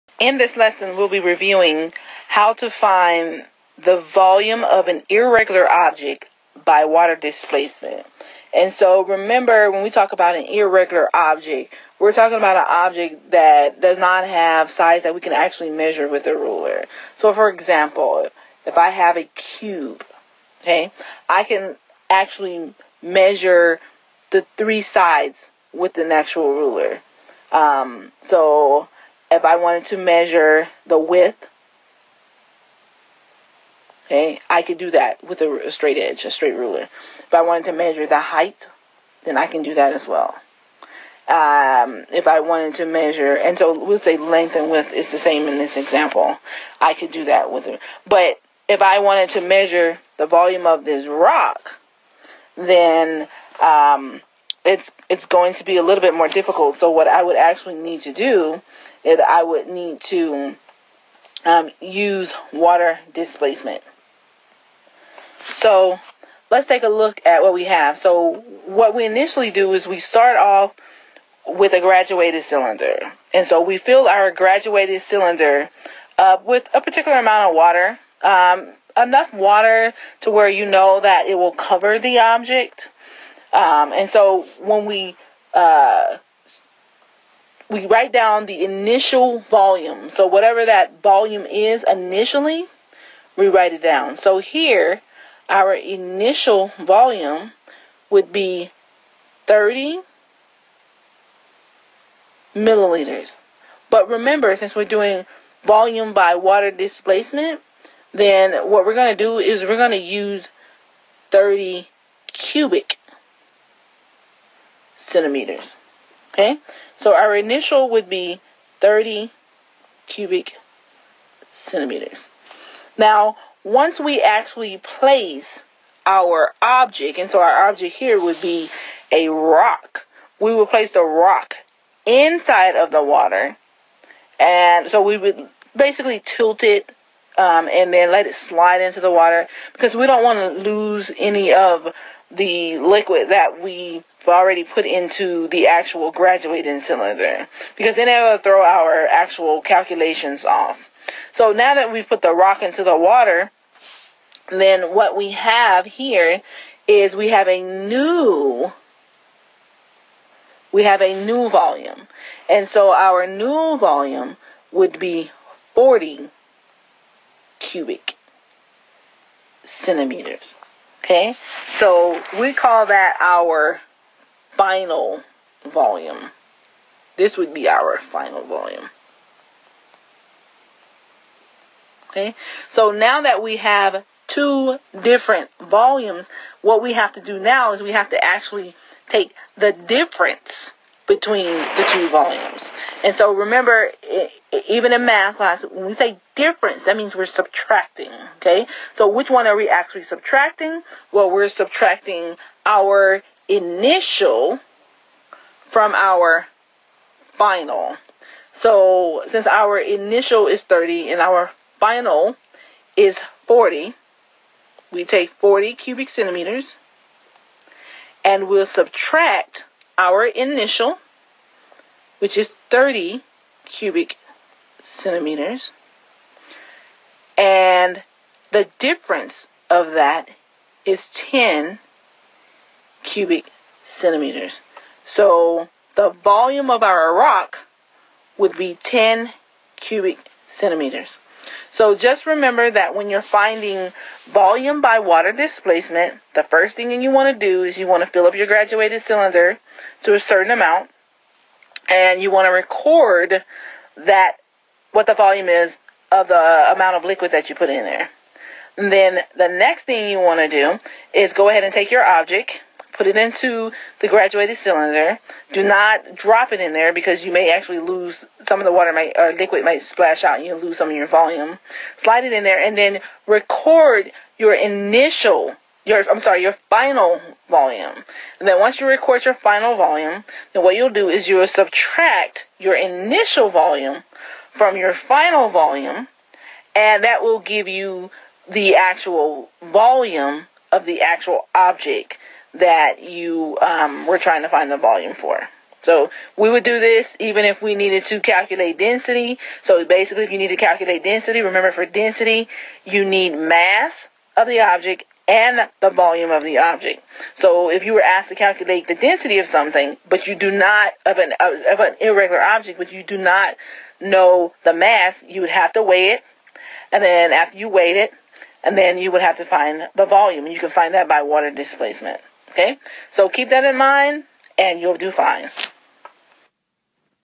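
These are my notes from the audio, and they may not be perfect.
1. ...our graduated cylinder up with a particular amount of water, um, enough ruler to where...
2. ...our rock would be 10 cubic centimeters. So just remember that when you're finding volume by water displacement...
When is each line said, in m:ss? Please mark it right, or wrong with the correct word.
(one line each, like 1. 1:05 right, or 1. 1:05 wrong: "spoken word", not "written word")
1. 1:14 wrong: "water", not "ruler"
2. 3:56 right.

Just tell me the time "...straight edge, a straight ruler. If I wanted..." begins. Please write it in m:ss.
0:35.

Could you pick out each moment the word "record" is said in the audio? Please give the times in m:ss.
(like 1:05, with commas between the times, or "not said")
4:12, 4:33, 4:38.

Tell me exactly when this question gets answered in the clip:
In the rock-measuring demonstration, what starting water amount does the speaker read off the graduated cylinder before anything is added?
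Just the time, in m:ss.
1:39.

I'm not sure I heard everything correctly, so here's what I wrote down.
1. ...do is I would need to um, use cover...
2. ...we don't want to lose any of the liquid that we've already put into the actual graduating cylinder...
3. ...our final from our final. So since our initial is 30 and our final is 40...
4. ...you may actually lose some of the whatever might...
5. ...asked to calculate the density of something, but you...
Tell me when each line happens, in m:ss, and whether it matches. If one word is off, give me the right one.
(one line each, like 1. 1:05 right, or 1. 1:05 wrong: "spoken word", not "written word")
1. 0:58 wrong: "water", not "cover"
2. 2:19 right
3. 3:22 wrong: "initial", not "final"
4. 4:27 wrong: "water", not "whatever"
5. 5:08 right.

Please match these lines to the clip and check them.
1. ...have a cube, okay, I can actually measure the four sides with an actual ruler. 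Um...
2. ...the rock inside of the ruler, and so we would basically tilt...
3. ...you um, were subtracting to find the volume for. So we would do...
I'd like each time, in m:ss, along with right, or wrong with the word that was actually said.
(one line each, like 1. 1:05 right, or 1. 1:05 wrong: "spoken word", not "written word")
1. 0:18 wrong: "three", not "four"
2. 2:10 wrong: "water", not "ruler"
3. 4:53 wrong: "trying", not "subtracting".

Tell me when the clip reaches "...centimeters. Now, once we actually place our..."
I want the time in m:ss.
2:01.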